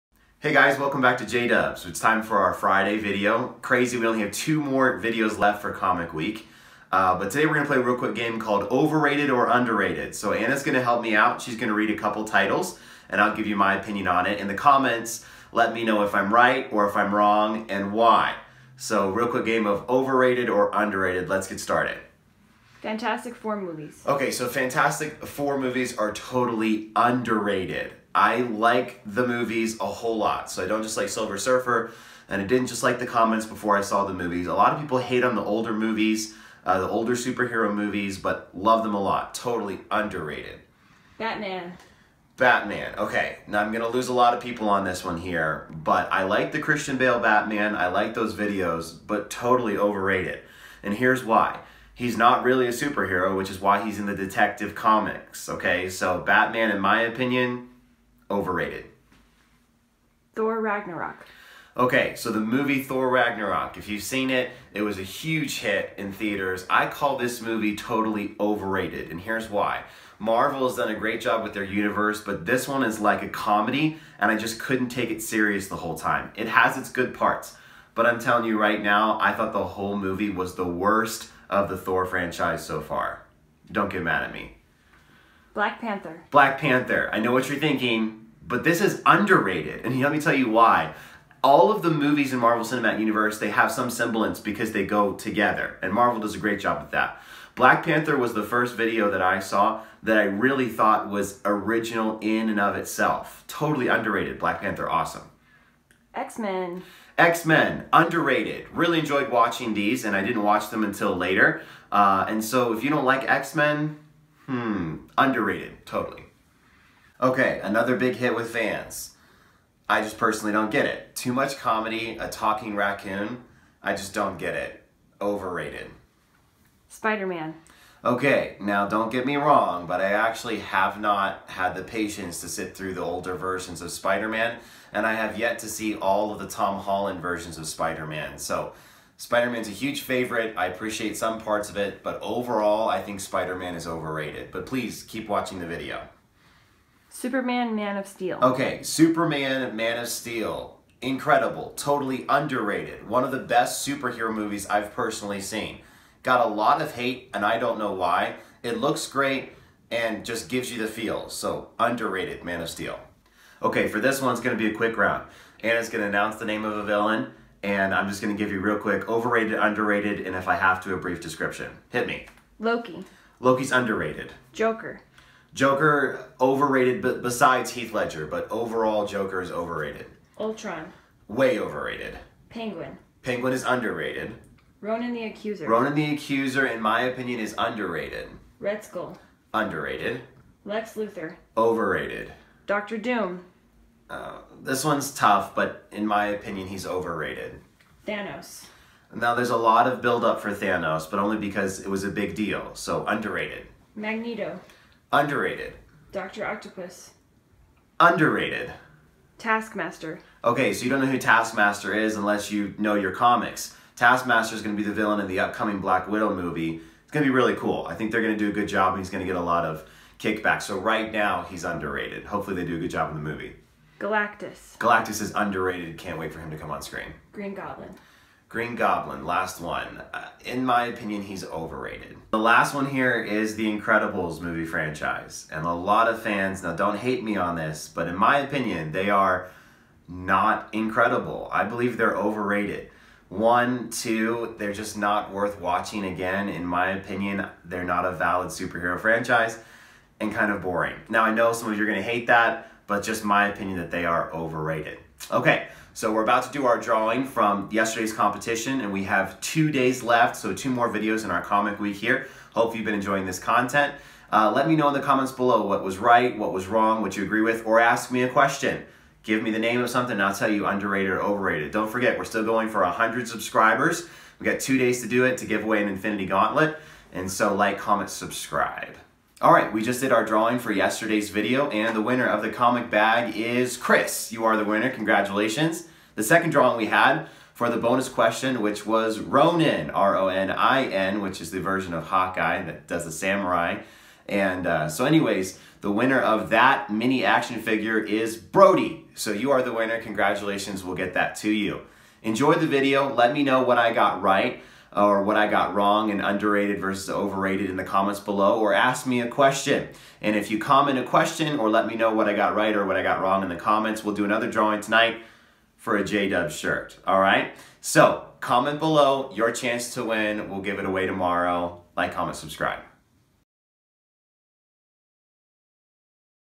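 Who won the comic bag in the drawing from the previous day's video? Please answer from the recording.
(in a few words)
Chris.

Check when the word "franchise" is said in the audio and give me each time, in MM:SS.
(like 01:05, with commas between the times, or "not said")
01:22, 03:54, 04:08.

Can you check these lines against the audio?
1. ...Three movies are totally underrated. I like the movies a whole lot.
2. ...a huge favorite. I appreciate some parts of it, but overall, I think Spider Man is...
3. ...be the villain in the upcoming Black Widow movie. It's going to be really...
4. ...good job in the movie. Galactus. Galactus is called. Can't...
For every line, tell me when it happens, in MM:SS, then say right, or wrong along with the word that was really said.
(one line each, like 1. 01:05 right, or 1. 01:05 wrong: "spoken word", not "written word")
1. 00:25 wrong: "Four", not "Three"
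2. 02:19 right
3. 03:34 right
4. 03:42 wrong: "underrated", not "called".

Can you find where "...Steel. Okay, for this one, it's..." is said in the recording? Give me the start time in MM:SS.
02:42.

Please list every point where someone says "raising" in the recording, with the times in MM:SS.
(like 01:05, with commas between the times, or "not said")
not said.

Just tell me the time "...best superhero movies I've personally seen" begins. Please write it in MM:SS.
02:33.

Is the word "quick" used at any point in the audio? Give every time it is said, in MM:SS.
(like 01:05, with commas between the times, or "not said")
00:07, 00:19, 02:44, 02:48.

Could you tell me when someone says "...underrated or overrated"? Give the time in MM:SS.
04:30.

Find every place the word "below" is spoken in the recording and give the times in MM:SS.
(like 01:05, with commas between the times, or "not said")
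04:25, 05:08, 05:18.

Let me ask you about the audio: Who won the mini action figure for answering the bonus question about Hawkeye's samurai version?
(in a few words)
Brody.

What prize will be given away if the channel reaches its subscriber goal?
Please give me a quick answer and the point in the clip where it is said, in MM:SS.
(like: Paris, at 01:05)
Infinity Gauntlet, at 04:35.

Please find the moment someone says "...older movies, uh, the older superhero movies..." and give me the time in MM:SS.
00:35.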